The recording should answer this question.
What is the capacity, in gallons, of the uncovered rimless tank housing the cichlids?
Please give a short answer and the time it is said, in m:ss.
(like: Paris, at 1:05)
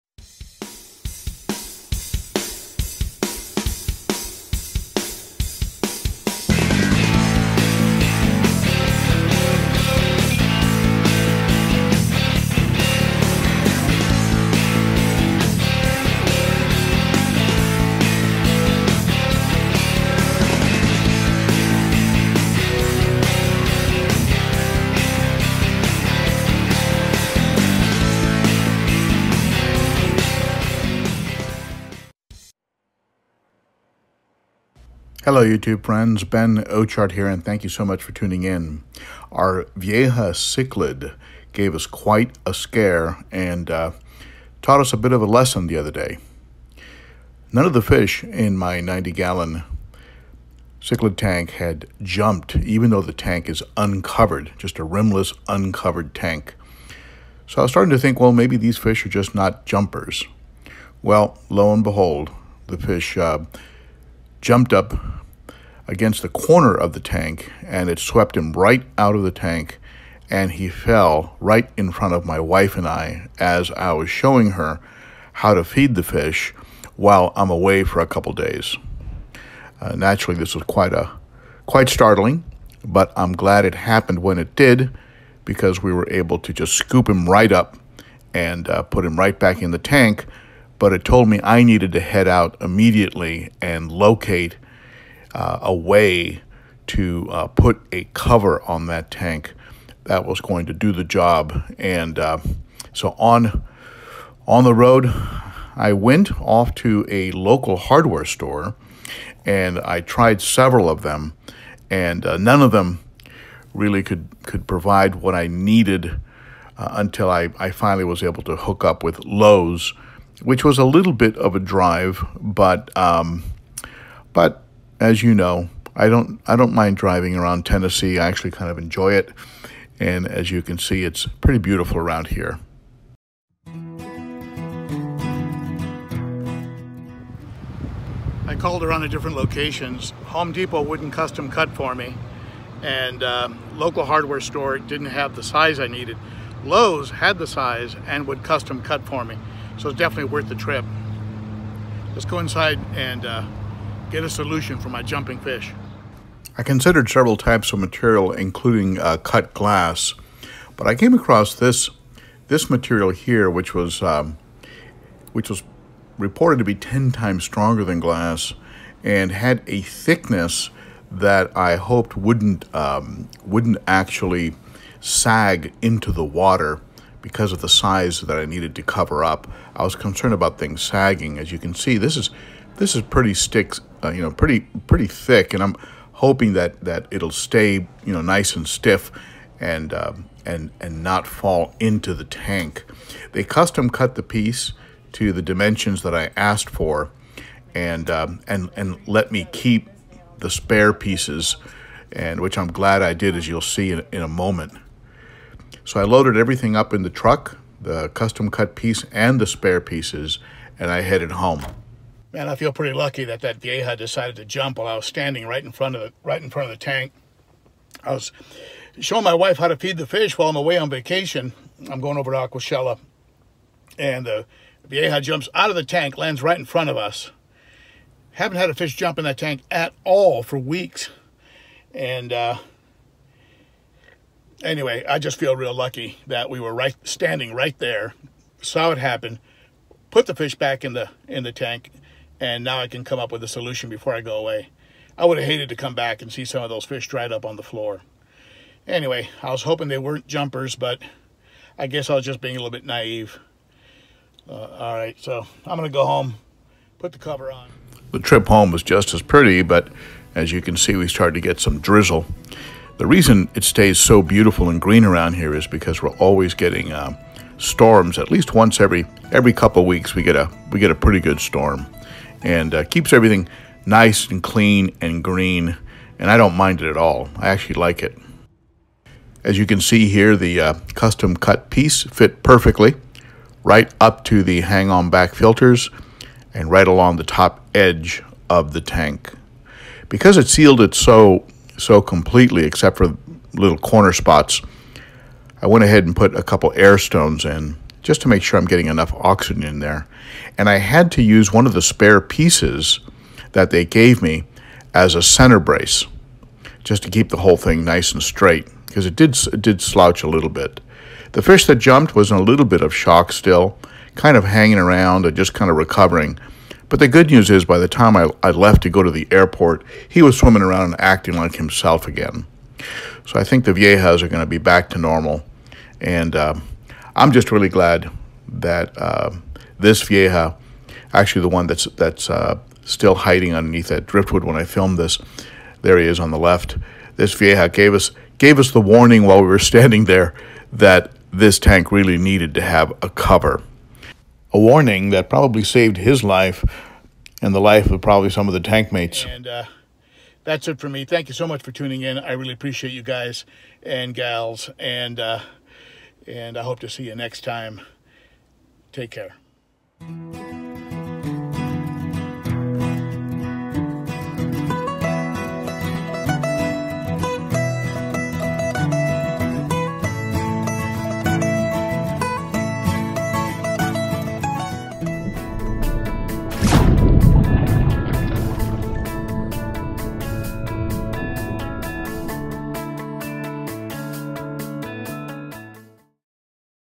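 90, at 0:48.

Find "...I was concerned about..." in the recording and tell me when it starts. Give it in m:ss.
2:59.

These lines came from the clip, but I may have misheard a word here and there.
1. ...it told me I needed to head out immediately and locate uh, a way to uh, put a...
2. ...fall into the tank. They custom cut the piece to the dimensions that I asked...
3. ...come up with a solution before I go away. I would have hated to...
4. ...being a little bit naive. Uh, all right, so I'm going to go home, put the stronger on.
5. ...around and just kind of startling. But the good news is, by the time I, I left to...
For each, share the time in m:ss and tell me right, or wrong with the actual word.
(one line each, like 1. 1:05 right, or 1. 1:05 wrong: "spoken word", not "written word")
1. 1:30 right
2. 3:11 right
3. 4:03 right
4. 4:12 wrong: "cover", not "stronger"
5. 5:14 wrong: "recovering", not "startling".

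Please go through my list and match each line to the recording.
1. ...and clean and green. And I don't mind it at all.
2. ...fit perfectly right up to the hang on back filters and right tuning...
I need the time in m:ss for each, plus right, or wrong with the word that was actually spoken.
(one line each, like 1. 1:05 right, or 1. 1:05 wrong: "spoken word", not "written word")
1. 4:34 right
2. 4:42 wrong: "along", not "tuning".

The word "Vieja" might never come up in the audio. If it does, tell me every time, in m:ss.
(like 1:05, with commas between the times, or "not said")
0:39, 3:33, 3:44, 5:23, 5:30, 5:37.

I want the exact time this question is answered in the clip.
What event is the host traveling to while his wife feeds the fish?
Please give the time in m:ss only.
3:42.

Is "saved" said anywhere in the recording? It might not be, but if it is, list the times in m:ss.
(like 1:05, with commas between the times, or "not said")
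5:45.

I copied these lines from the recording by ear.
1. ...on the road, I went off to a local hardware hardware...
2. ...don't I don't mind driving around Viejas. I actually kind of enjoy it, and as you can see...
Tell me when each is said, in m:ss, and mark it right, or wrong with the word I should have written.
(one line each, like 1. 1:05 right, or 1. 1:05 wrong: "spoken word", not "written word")
1. 1:44 wrong: "store", not "hardware"
2. 2:06 wrong: "Tennessee", not "Viejas".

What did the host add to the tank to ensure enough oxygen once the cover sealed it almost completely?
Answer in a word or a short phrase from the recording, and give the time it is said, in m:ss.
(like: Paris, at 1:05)
air stones, at 4:56.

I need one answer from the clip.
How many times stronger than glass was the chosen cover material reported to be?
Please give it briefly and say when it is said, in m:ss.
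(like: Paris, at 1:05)
10, at 2:46.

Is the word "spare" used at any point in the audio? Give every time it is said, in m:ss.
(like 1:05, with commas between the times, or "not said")
3:20, 3:29, 5:01.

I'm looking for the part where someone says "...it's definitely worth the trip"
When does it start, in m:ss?
2:29.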